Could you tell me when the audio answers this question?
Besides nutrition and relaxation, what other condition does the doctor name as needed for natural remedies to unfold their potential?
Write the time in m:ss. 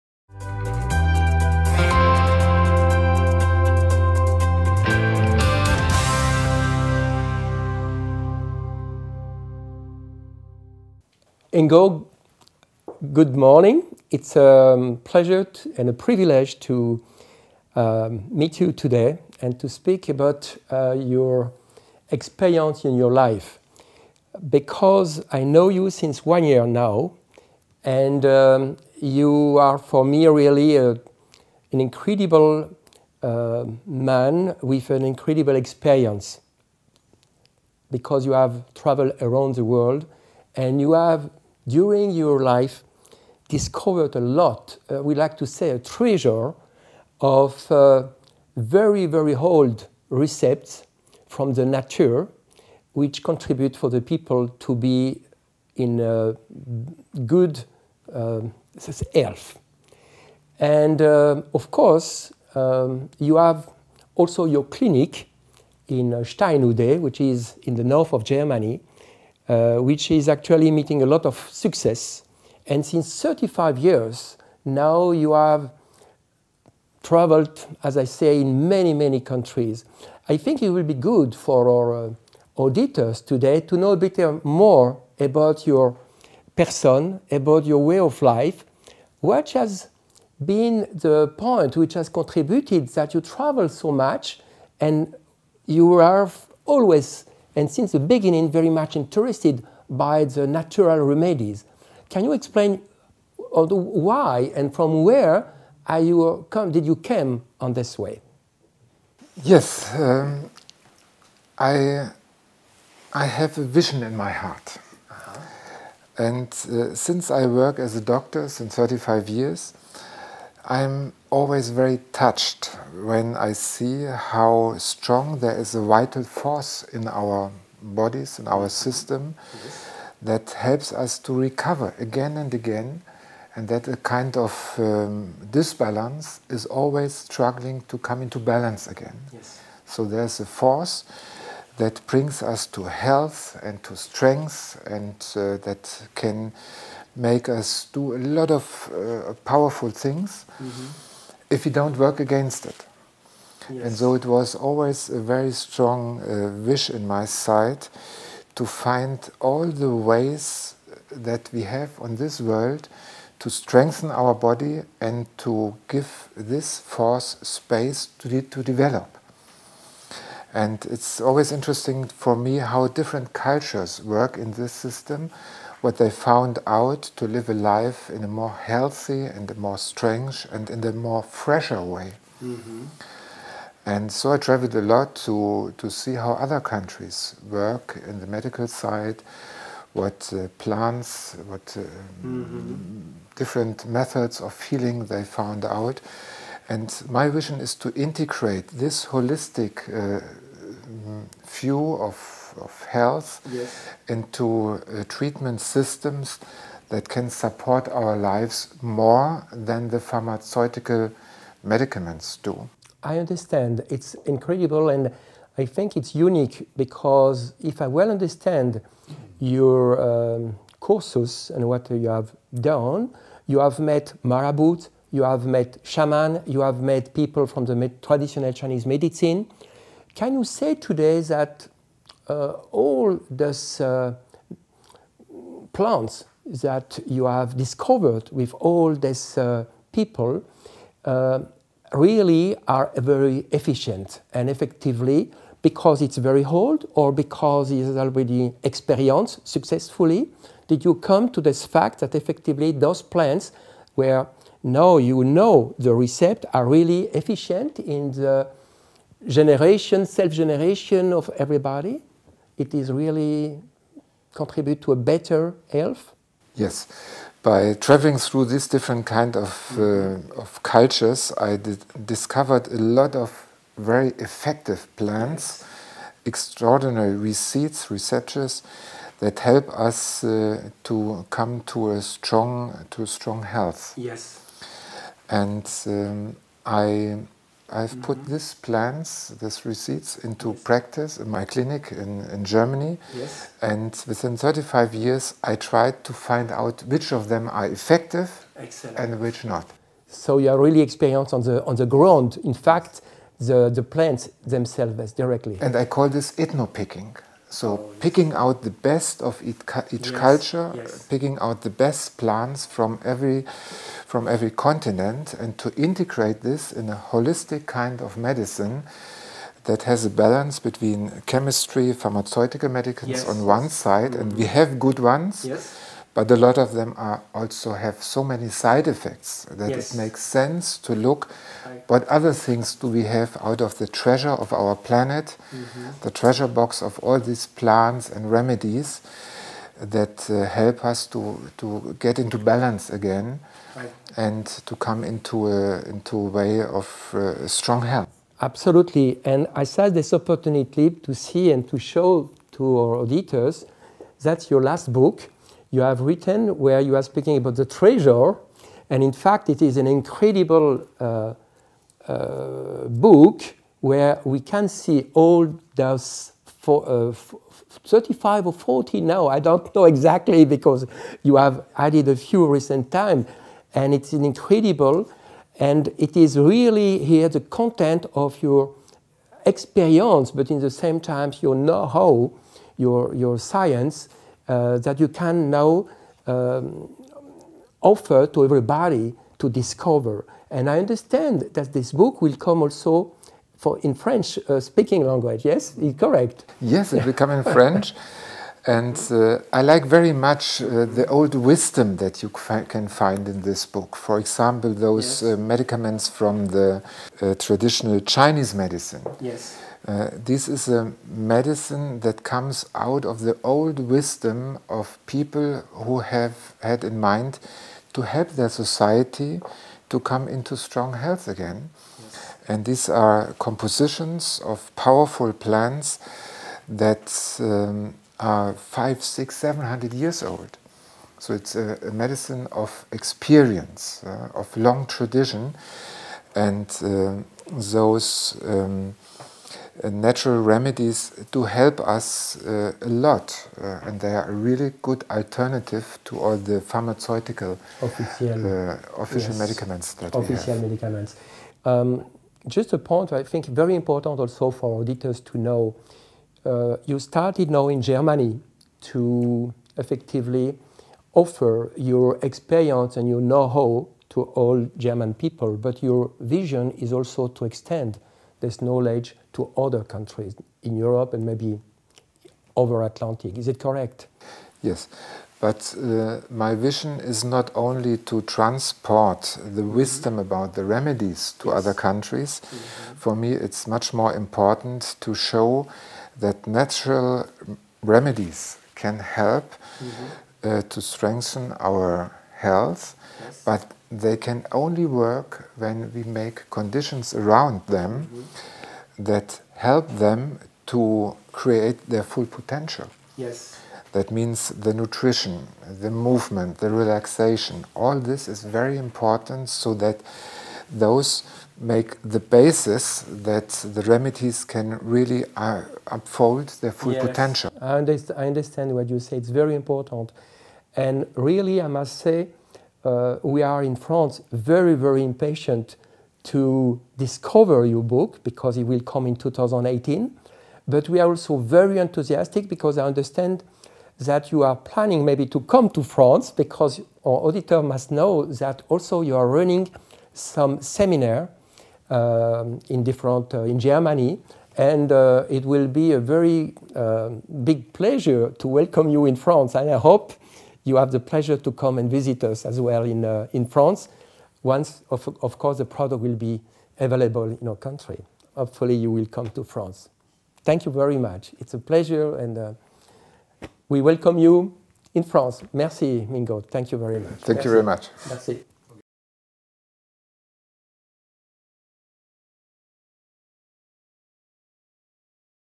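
8:25.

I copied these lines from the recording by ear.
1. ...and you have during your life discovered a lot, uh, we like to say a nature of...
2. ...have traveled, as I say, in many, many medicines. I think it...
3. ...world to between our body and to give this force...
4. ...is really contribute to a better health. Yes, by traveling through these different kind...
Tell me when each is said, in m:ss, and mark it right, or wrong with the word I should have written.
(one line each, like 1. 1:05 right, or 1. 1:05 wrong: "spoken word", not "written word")
1. 0:40 wrong: "treasure", not "nature"
2. 1:15 wrong: "countries", not "medicines"
3. 2:42 wrong: "strengthen", not "between"
4. 4:22 right.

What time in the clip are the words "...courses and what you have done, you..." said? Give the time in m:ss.
3:40.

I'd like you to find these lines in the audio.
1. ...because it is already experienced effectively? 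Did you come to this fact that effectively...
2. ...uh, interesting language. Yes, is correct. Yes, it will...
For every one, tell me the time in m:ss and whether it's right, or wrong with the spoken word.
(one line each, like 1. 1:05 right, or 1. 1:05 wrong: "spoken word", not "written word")
1. 4:07 wrong: "successfully", not "effectively"
2. 6:34 wrong: "speaking", not "interesting".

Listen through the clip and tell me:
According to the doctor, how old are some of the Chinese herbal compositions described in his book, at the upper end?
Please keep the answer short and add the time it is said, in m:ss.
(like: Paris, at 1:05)
700 years, at 7:09.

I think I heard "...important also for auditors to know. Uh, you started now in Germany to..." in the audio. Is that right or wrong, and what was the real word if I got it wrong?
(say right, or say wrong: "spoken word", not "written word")
right.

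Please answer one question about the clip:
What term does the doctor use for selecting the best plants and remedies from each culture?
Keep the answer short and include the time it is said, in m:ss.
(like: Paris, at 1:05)
Ethno-picking, at 5:06.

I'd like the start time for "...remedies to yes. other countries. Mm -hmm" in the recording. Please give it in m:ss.
8:00.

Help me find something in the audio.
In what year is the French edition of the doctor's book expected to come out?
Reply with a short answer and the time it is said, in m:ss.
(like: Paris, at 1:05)
2018, at 8:49.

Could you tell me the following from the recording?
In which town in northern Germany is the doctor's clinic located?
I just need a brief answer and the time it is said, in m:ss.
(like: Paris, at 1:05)
Steinhude, at 1:06.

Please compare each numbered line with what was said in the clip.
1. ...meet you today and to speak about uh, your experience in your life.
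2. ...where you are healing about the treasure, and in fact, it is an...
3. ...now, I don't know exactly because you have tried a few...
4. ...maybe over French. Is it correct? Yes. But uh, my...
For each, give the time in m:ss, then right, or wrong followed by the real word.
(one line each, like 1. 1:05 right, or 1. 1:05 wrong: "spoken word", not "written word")
1. 0:18 right
2. 5:56 wrong: "speaking", not "healing"
3. 6:09 wrong: "added", not "tried"
4. 7:51 wrong: "Atlantic", not "French".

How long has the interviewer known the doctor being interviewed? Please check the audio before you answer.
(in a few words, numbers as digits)
One year.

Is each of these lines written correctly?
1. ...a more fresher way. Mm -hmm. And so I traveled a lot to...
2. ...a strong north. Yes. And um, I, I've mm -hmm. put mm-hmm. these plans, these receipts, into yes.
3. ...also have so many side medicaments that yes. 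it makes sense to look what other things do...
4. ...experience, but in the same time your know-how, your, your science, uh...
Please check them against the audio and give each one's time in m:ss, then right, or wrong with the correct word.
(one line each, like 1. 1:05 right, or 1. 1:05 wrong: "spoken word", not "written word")
1. 3:00 right
2. 4:43 wrong: "health", not "north"
3. 5:27 wrong: "effects", not "medicaments"
4. 6:19 right.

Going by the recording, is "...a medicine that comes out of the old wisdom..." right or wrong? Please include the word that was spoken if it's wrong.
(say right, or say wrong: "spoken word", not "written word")
right.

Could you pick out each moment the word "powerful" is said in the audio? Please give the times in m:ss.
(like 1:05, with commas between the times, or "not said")
2:29, 7:04.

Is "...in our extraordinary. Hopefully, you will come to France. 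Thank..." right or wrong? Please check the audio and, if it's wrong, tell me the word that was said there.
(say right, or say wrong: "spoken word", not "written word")
wrong: "country", not "extraordinary".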